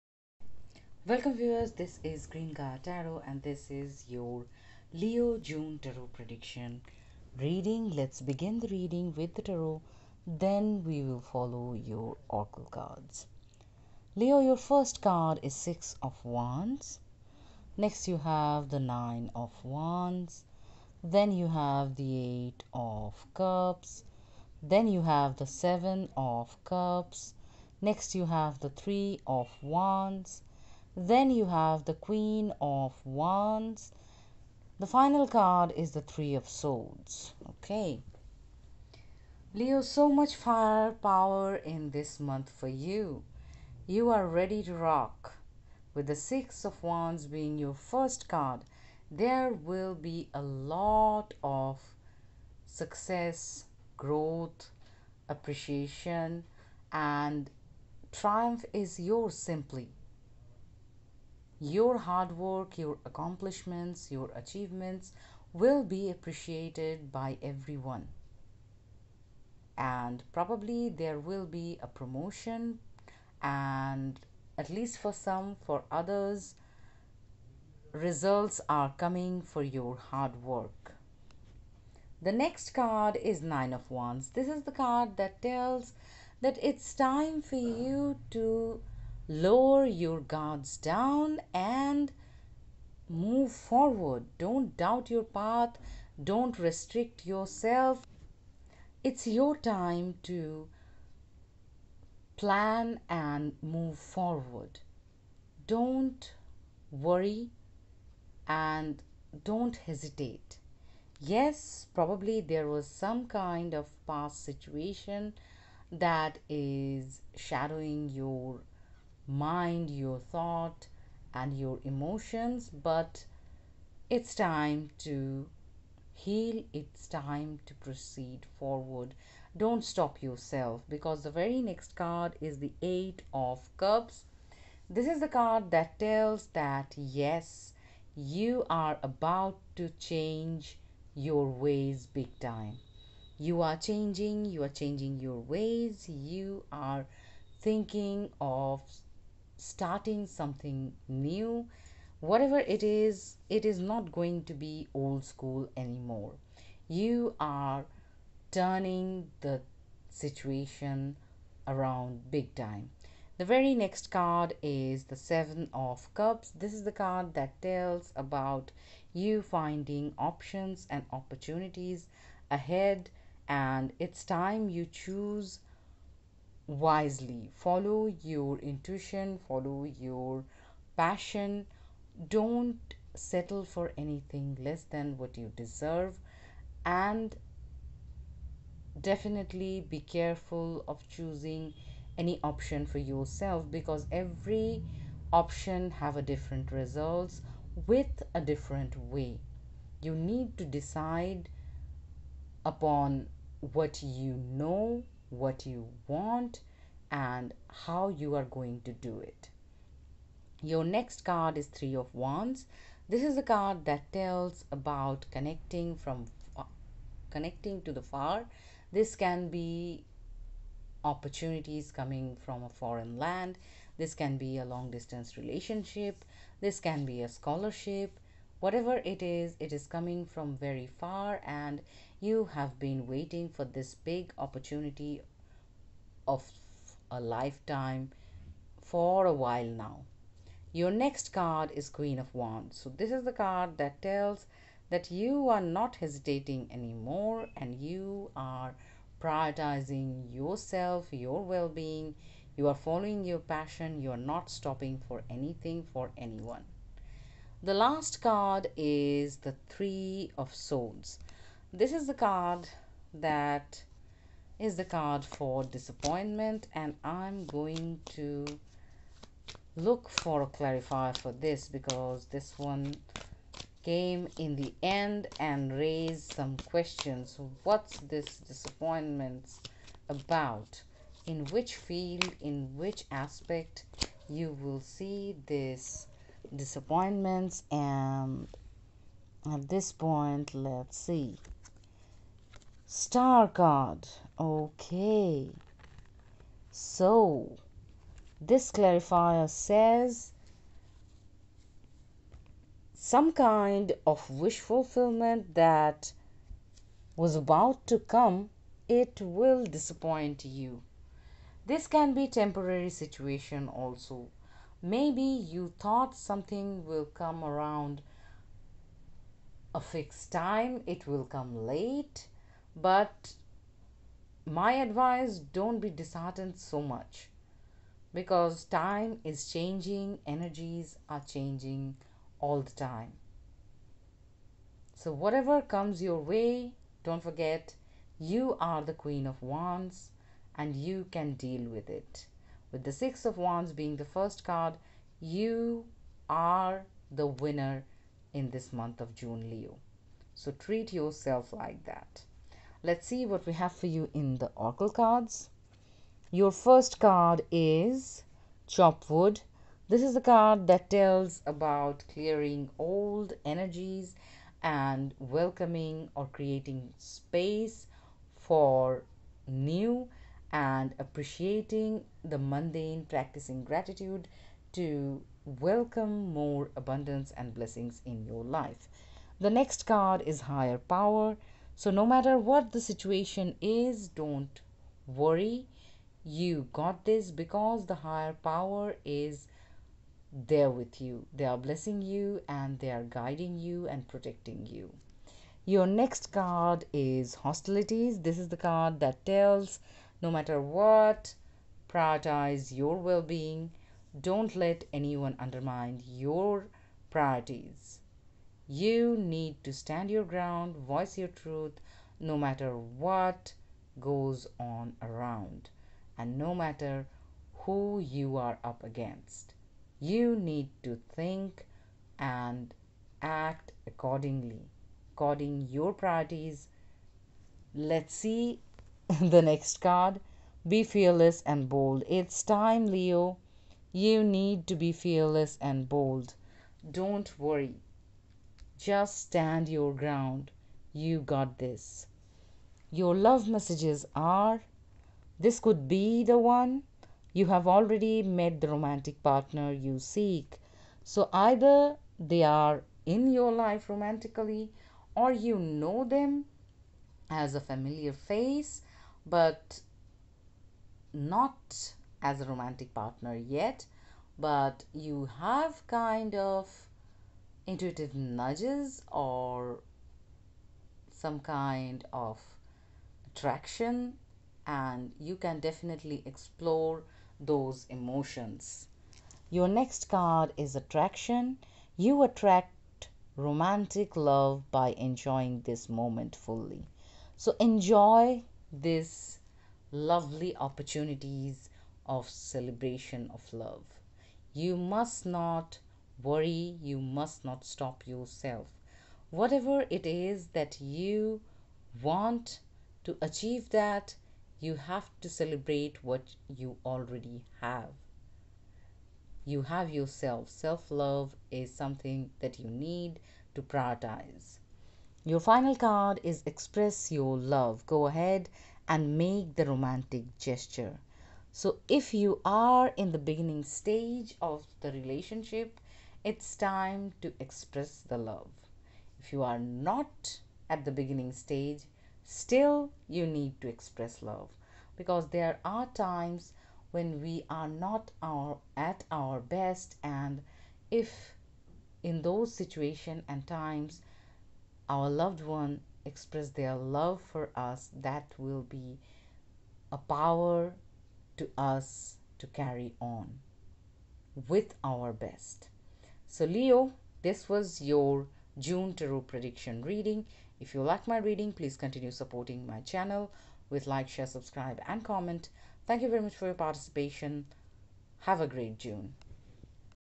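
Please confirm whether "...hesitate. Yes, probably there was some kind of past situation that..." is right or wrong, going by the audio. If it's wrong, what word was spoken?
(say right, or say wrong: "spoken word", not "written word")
right.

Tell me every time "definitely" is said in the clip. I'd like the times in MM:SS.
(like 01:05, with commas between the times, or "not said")
03:08, 07:55.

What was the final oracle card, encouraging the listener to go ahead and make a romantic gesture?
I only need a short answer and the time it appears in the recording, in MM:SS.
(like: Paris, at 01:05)
Express Your Love, at 08:36.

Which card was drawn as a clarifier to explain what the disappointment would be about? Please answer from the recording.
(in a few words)
Star card.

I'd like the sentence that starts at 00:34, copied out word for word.
The final card is the Three of Swords.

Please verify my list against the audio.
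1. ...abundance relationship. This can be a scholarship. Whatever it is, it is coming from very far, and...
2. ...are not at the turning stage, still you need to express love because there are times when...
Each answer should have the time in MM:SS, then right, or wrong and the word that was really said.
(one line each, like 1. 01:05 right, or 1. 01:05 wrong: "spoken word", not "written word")
1. 03:44 wrong: "distance", not "abundance"
2. 08:49 wrong: "beginning", not "turning".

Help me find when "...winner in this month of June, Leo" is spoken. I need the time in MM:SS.
05:47.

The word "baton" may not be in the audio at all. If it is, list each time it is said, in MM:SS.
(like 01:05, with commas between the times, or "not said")
not said.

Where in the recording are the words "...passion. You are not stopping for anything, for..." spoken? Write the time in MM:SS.
04:13.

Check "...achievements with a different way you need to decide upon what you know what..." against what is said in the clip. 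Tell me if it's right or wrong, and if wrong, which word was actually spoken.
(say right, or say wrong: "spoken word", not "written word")
wrong: "results", not "achievements".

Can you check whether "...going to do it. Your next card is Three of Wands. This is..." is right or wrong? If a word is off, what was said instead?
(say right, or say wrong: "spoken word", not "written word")
right.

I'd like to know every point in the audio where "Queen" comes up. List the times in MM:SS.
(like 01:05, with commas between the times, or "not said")
00:31, 04:01, 05:38.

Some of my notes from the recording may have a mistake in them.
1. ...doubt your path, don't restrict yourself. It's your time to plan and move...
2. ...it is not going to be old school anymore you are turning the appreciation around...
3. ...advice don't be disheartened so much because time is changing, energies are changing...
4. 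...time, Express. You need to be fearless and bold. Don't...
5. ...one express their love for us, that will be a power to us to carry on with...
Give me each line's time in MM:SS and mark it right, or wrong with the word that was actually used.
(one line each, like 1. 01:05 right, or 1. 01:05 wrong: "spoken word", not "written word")
1. 01:34 right
2. 02:33 wrong: "situation", not "appreciation"
3. 05:24 right
4. 07:12 wrong: "Leo", not "Express"
5. 09:05 right.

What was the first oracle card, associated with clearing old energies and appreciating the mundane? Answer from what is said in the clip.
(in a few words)
Chop wood.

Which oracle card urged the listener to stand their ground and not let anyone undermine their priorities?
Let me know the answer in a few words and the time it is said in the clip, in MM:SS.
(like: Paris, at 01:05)
Hostilities, at 06:37.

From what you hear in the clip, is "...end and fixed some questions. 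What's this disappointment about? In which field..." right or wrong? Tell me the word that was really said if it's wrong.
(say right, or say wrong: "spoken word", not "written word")
wrong: "raised", not "fixed".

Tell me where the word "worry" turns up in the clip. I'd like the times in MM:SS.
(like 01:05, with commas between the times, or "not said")
01:46, 06:25, 07:17, 08:16.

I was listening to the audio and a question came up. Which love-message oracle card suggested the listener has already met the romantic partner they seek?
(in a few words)
This could be the one.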